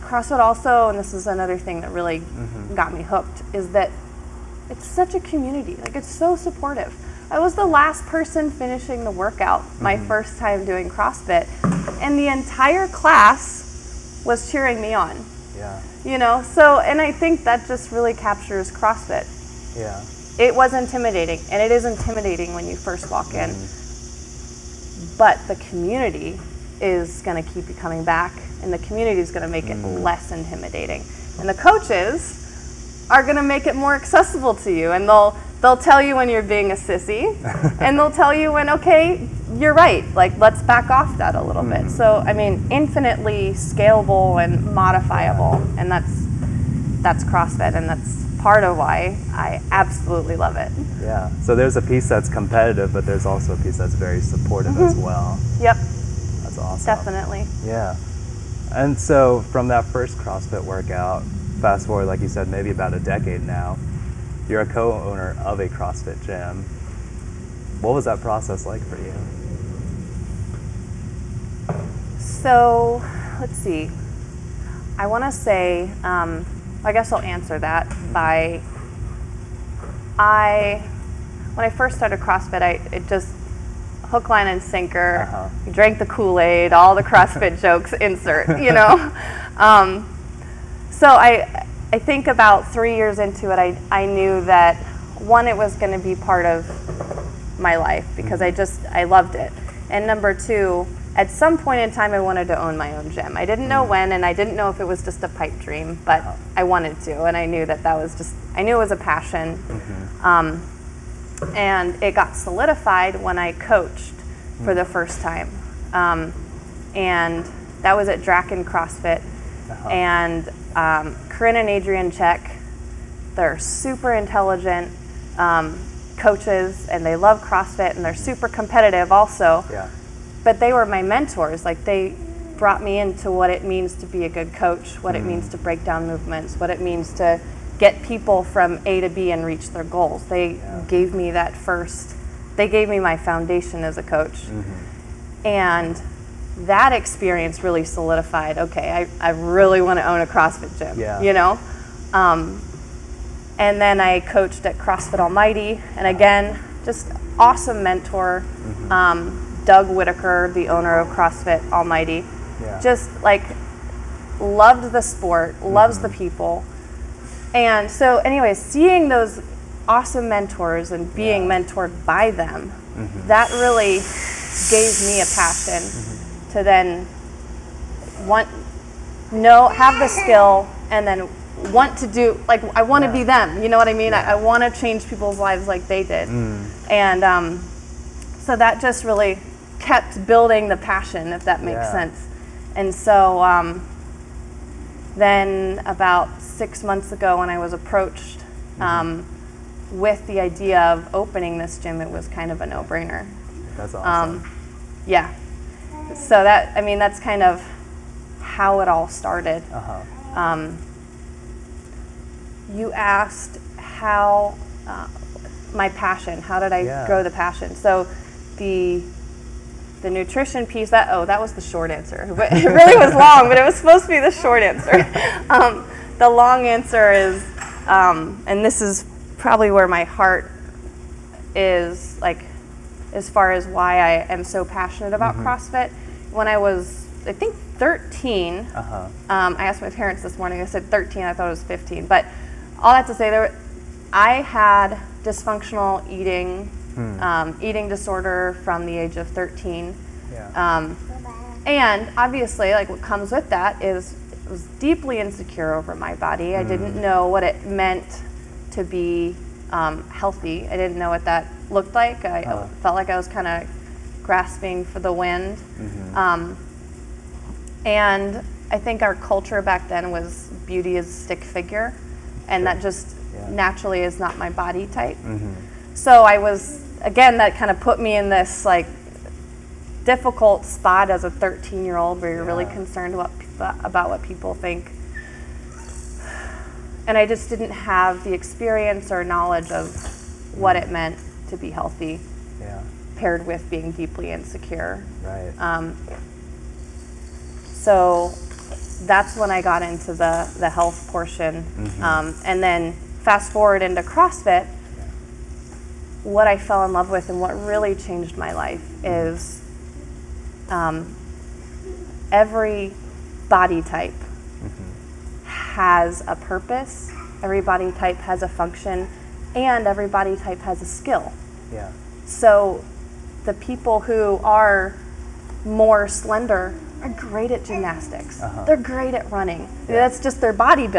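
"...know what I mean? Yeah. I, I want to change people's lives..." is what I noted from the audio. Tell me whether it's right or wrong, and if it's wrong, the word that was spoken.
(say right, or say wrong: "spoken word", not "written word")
right.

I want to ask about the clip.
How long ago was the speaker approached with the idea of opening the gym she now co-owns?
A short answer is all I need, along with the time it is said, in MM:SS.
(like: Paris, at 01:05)
6 months, at 03:16.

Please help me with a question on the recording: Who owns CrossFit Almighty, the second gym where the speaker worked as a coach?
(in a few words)
Doug Whitaker.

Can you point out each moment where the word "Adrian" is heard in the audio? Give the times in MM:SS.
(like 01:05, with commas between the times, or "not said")
02:01.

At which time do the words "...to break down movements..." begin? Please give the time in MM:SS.
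02:15.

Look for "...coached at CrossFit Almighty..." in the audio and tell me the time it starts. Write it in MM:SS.
02:34.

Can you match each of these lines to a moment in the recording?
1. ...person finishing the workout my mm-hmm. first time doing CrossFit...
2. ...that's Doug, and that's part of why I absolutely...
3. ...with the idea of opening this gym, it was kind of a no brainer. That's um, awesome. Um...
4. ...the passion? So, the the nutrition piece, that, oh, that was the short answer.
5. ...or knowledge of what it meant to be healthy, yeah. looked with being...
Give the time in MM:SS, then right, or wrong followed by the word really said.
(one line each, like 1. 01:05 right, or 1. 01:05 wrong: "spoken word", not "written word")
1. 00:08 right
2. 00:47 wrong: "CrossFit", not "Doug"
3. 03:19 right
4. 03:37 right
5. 04:49 wrong: "paired", not "looked".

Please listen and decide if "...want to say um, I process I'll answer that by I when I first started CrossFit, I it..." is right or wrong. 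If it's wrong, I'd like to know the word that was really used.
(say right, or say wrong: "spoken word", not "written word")
wrong: "guess", not "process".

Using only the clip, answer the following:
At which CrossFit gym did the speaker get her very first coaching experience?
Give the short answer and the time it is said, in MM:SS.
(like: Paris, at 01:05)
Draken CrossFit, at 01:58.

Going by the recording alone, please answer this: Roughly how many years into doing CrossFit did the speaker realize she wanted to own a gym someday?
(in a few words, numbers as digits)
3.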